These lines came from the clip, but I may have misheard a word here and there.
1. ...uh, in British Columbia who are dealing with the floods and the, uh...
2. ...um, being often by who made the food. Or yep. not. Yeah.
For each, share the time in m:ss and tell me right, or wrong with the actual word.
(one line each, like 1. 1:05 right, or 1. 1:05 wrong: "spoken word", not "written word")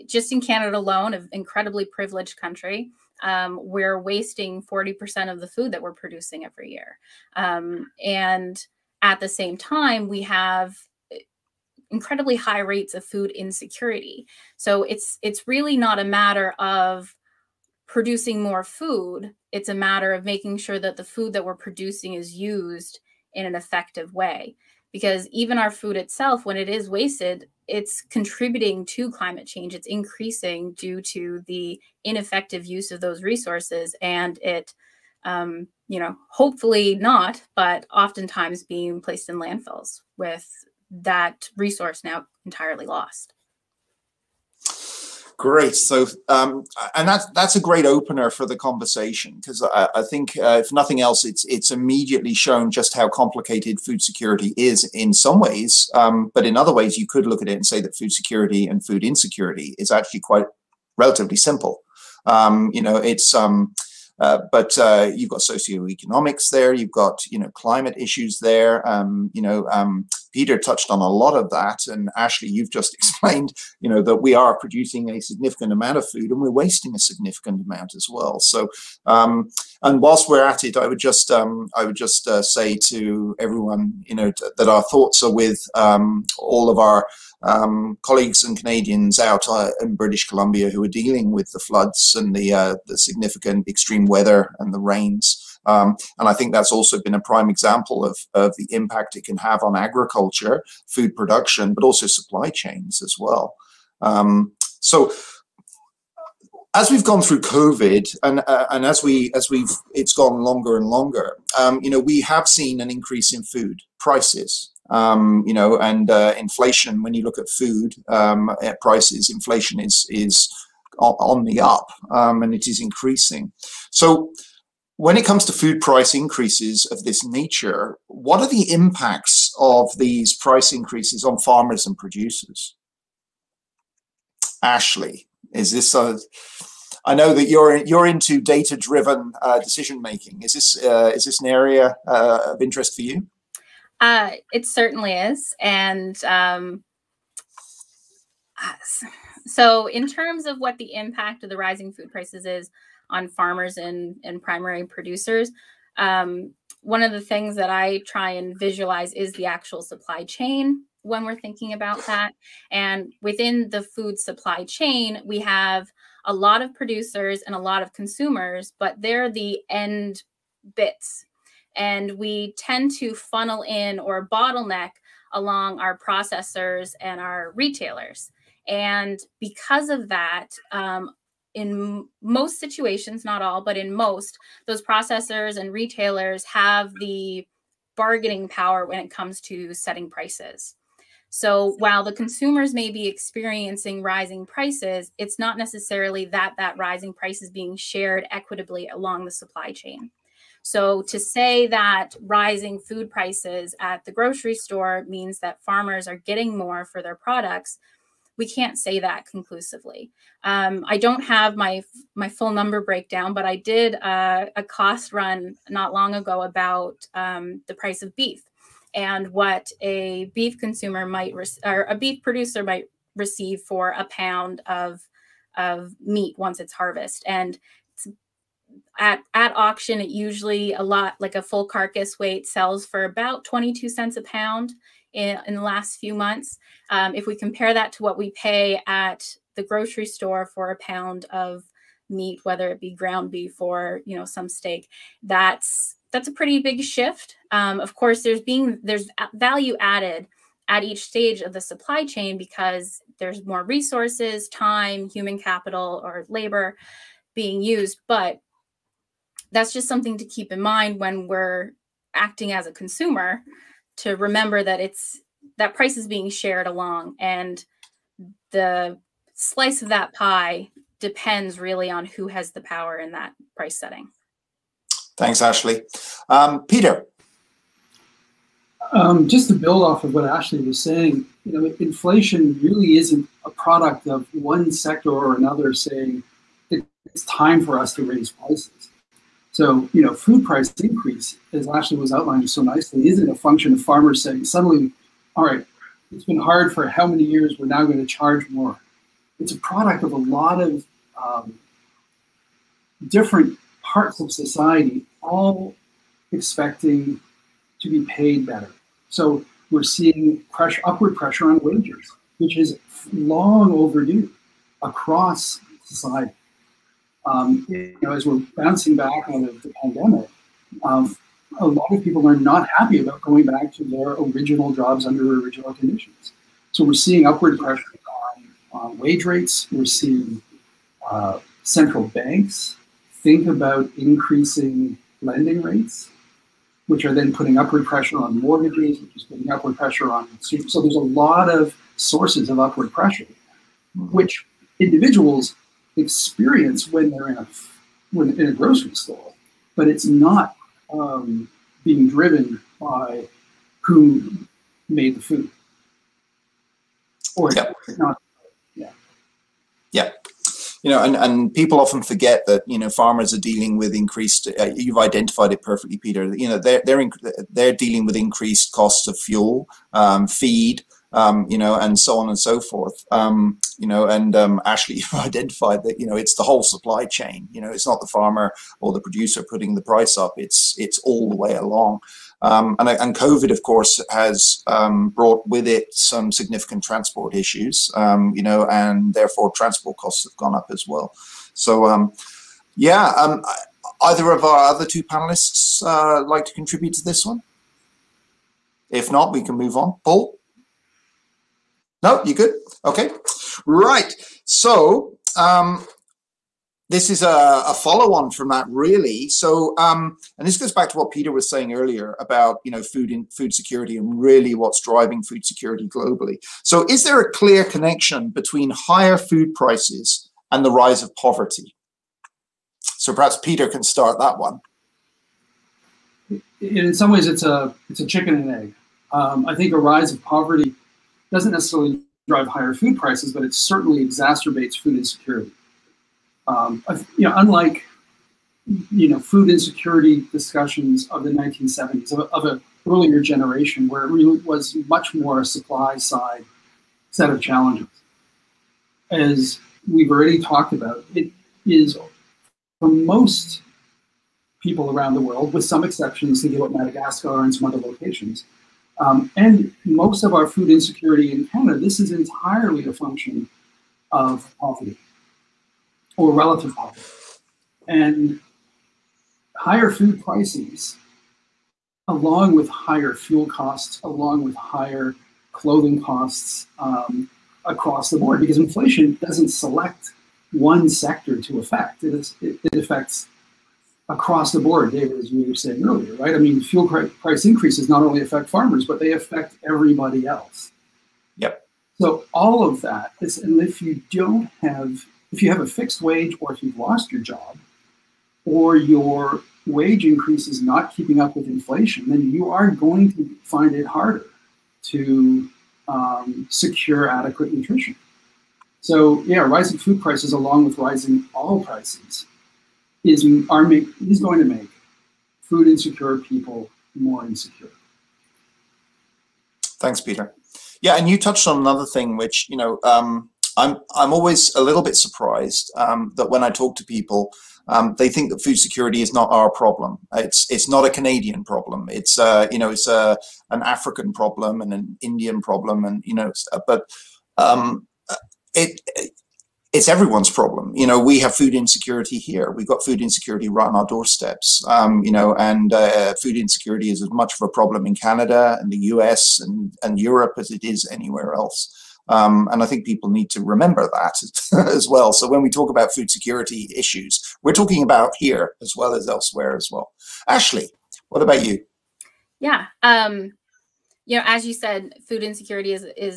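1. 1:29 right
2. 5:50 wrong: "driven", not "often".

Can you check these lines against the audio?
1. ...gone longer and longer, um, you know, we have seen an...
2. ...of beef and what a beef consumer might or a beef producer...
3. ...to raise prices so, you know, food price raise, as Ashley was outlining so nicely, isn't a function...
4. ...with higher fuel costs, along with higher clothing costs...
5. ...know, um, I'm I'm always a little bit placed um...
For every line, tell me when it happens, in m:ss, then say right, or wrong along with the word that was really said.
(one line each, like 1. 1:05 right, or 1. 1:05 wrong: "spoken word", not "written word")
1. 1:50 right
2. 3:38 right
3. 4:47 wrong: "increase", not "raise"
4. 7:52 right
5. 8:42 wrong: "surprised", not "placed".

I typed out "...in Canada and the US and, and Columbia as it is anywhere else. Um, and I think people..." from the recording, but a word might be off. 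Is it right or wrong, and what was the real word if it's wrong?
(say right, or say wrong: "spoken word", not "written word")
wrong: "Europe", not "Columbia".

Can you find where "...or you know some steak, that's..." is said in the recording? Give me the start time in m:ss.
4:03.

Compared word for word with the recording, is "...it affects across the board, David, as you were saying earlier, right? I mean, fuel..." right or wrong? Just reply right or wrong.
right.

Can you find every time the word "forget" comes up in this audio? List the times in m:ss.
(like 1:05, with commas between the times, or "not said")
6:02.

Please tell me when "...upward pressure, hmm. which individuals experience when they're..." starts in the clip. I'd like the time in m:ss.
5:42.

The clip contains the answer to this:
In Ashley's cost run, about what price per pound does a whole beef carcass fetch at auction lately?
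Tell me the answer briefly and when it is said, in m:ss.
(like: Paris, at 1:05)
22 cents, at 3:53.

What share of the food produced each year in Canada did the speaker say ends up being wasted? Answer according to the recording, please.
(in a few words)
40%.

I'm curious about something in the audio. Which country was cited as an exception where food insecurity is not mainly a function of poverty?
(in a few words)
Madagascar.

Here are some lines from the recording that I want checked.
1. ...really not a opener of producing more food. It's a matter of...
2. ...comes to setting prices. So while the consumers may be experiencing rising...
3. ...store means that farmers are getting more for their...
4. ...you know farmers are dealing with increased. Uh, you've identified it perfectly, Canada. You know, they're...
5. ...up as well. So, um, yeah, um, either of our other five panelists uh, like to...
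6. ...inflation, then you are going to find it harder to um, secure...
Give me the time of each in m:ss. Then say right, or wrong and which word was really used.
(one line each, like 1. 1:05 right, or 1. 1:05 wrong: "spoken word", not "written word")
1. 0:15 wrong: "matter", not "opener"
2. 3:09 right
3. 3:24 right
4. 6:02 wrong: "Peter", not "Canada"
5. 6:30 wrong: "two", not "five"
6. 8:21 right.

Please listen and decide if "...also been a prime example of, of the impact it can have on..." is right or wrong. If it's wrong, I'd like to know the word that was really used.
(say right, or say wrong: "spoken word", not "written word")
right.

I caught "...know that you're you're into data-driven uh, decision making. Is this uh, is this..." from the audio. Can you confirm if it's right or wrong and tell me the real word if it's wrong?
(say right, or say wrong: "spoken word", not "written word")
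right.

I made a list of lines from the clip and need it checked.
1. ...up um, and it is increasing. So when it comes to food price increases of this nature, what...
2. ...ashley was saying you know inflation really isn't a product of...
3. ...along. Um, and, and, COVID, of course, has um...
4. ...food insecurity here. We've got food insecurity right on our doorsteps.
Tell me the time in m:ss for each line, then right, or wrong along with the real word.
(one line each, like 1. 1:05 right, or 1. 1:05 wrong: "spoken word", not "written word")
1. 2:01 right
2. 4:40 right
3. 6:21 right
4. 9:01 right.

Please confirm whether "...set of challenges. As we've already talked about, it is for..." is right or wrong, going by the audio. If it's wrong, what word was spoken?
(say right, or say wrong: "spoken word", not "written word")
right.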